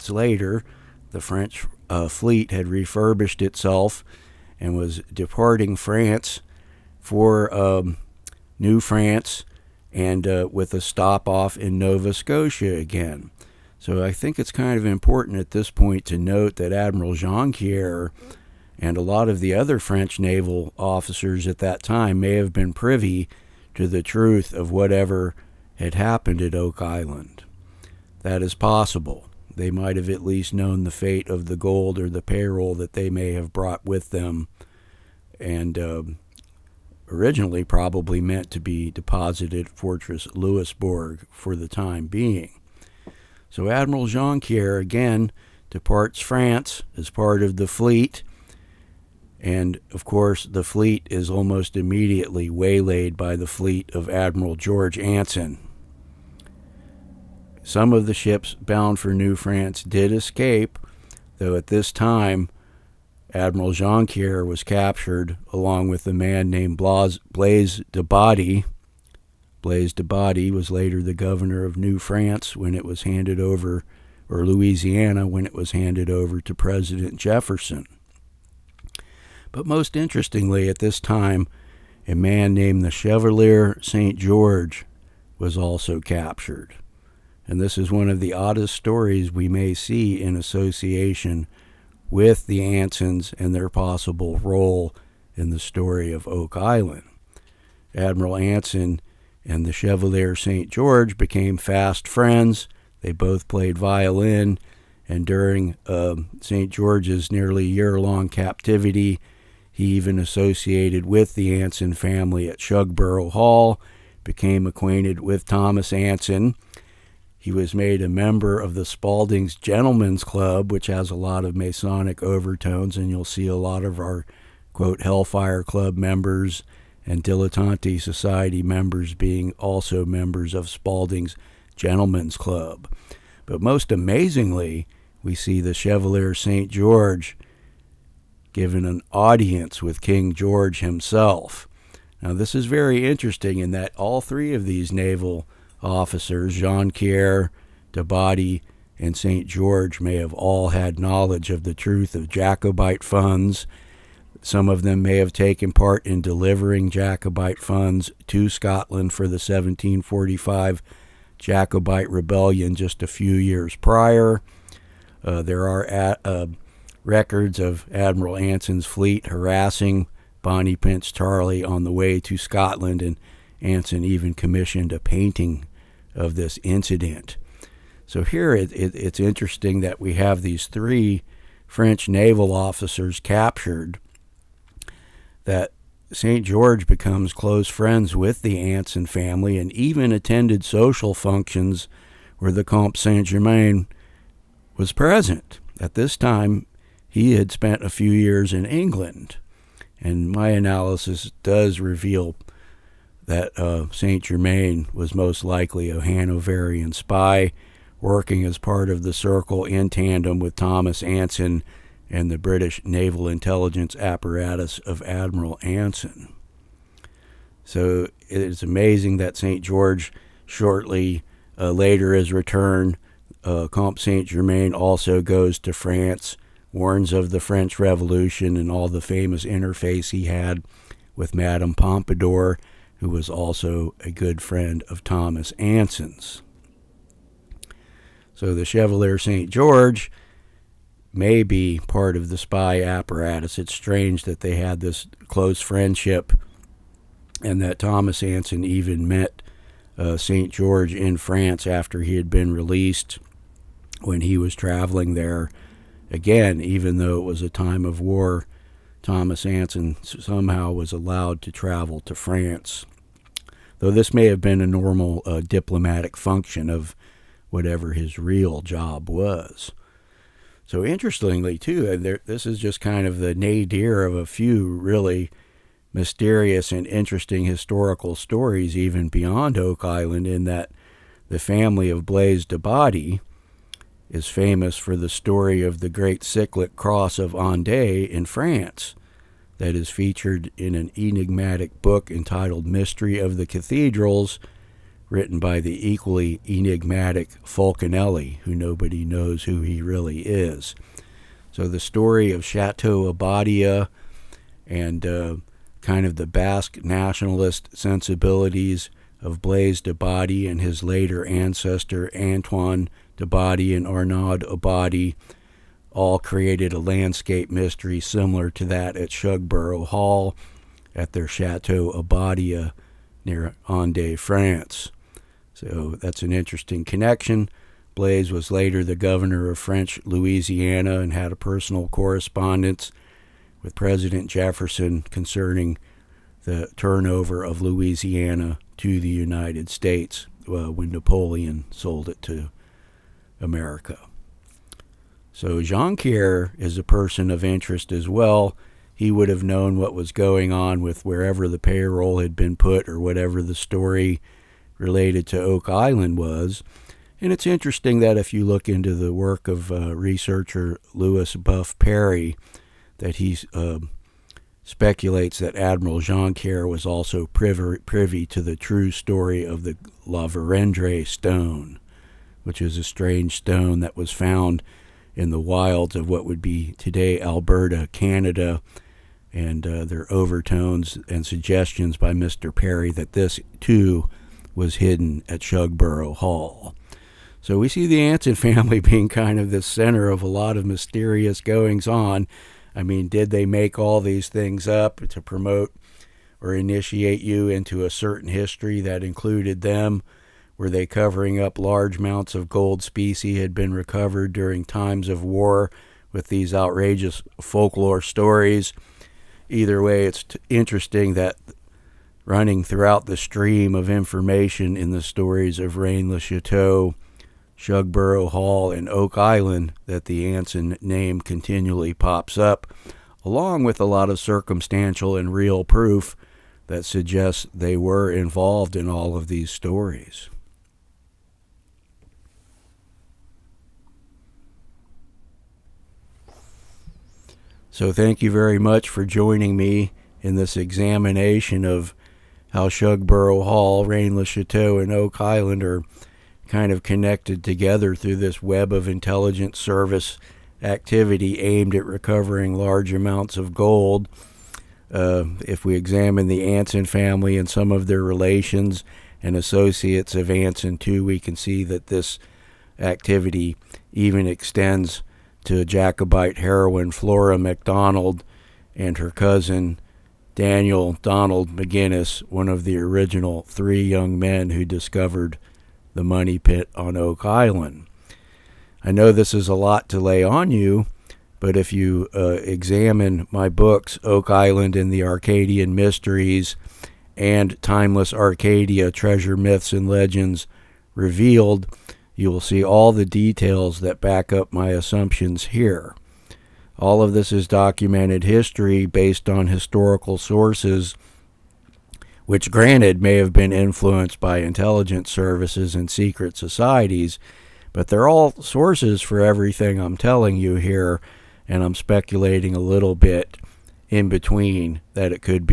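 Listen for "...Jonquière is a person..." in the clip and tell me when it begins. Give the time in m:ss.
5:45.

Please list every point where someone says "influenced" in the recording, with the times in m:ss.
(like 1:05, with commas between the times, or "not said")
8:23.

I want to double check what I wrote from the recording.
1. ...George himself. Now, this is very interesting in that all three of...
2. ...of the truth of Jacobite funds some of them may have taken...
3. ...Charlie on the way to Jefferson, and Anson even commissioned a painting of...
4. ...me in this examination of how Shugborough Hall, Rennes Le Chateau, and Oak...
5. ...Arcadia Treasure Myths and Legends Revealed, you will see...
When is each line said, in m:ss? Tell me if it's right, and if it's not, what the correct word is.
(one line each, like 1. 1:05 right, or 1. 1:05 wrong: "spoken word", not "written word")
1. 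2:20 right
2. 2:31 right
3. 2:51 wrong: "Scotland", not "Jefferson"
4. 7:19 right
5. 8:08 right.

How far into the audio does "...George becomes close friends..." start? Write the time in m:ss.
3:06.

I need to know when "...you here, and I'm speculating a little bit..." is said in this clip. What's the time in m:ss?
8:30.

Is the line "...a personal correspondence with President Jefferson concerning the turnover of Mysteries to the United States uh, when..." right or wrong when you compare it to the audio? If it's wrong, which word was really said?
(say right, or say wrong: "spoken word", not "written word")
wrong: "Louisiana", not "Mysteries".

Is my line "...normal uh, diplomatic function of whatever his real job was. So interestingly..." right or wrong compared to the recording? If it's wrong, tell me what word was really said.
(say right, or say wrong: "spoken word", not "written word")
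right.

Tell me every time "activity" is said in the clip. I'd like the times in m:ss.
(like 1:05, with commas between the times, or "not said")
7:30, 7:42.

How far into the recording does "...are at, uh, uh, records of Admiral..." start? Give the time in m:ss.
2:45.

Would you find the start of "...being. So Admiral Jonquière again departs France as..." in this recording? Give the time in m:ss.
0:42.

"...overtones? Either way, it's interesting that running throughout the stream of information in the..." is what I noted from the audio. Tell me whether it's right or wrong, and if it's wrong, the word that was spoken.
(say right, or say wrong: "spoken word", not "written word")
wrong: "stories", not "overtones".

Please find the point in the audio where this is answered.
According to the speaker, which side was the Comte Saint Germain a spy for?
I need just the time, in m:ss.
3:26.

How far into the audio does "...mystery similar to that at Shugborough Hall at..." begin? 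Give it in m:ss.
5:17.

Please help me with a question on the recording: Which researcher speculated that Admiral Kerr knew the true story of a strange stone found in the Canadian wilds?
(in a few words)
Louis Buff Parry.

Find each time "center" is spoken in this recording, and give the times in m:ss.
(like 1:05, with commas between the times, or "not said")
6:29.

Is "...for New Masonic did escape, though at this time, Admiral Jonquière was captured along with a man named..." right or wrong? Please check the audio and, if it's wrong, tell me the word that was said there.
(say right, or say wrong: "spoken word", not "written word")
wrong: "France", not "Masonic".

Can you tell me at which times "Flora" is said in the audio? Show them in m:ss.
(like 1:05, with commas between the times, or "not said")
7:46.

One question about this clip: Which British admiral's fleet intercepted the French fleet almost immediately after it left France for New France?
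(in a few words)
George Anson.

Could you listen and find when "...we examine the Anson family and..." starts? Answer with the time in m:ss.
7:35.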